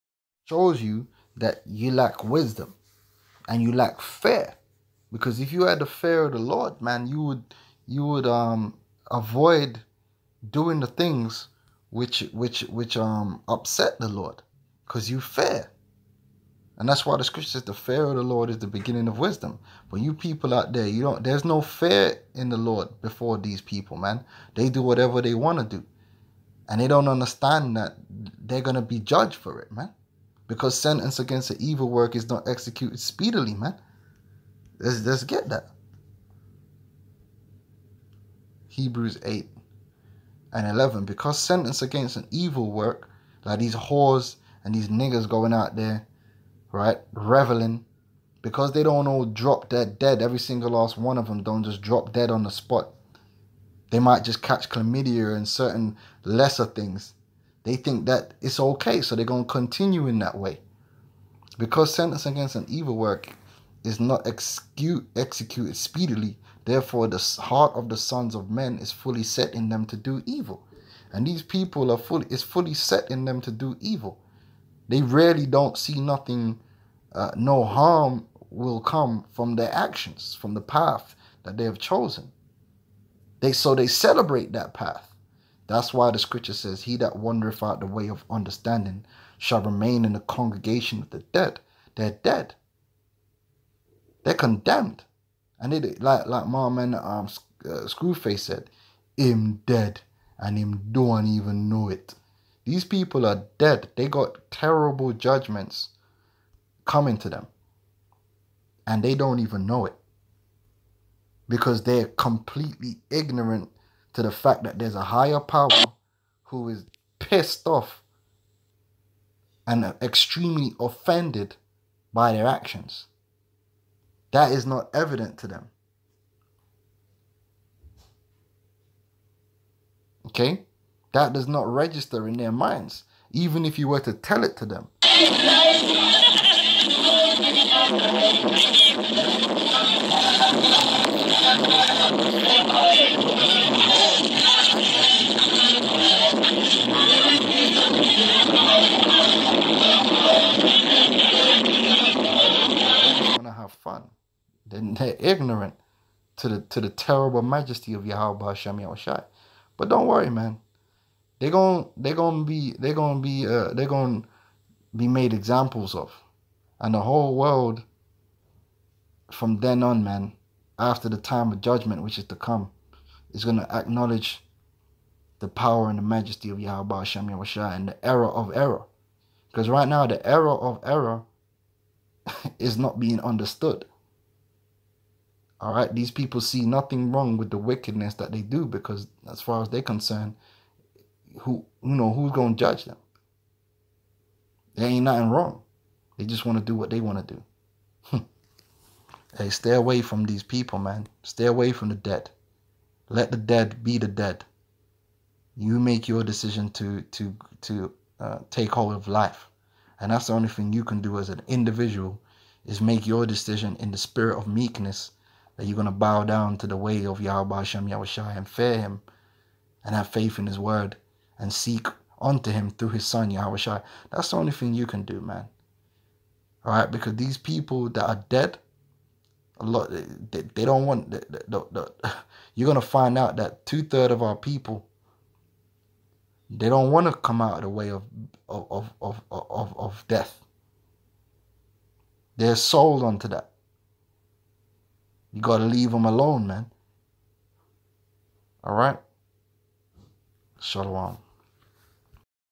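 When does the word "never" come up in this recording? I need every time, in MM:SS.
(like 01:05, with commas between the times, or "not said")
not said.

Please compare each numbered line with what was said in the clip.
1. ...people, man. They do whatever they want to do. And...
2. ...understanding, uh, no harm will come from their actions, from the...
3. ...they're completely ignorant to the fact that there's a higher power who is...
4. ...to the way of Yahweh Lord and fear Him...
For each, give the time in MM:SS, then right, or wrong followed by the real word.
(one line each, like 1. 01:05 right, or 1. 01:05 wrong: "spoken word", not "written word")
1. 00:23 right
2. 01:15 wrong: "nothing", not "understanding"
3. 01:51 right
4. 03:36 wrong: "Yahushua", not "Lord".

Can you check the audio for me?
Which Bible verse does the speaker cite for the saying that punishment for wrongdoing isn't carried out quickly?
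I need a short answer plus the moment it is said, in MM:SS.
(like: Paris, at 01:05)
Hebrews 8:11, at 00:38.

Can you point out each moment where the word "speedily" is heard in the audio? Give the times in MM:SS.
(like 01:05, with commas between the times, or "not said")
00:32, 01:05.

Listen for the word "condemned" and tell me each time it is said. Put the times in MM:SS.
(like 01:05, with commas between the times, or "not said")
01:34.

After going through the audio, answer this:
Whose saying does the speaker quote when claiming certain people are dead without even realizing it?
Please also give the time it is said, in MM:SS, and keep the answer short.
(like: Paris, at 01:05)
Screwface, at 01:37.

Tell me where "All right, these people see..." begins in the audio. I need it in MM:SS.
03:05.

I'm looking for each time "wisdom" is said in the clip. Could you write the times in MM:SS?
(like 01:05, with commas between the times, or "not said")
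00:02, 00:19.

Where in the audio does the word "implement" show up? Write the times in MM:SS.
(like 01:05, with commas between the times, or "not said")
not said.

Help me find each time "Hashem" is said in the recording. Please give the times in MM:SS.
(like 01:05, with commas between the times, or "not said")
02:38, 02:56.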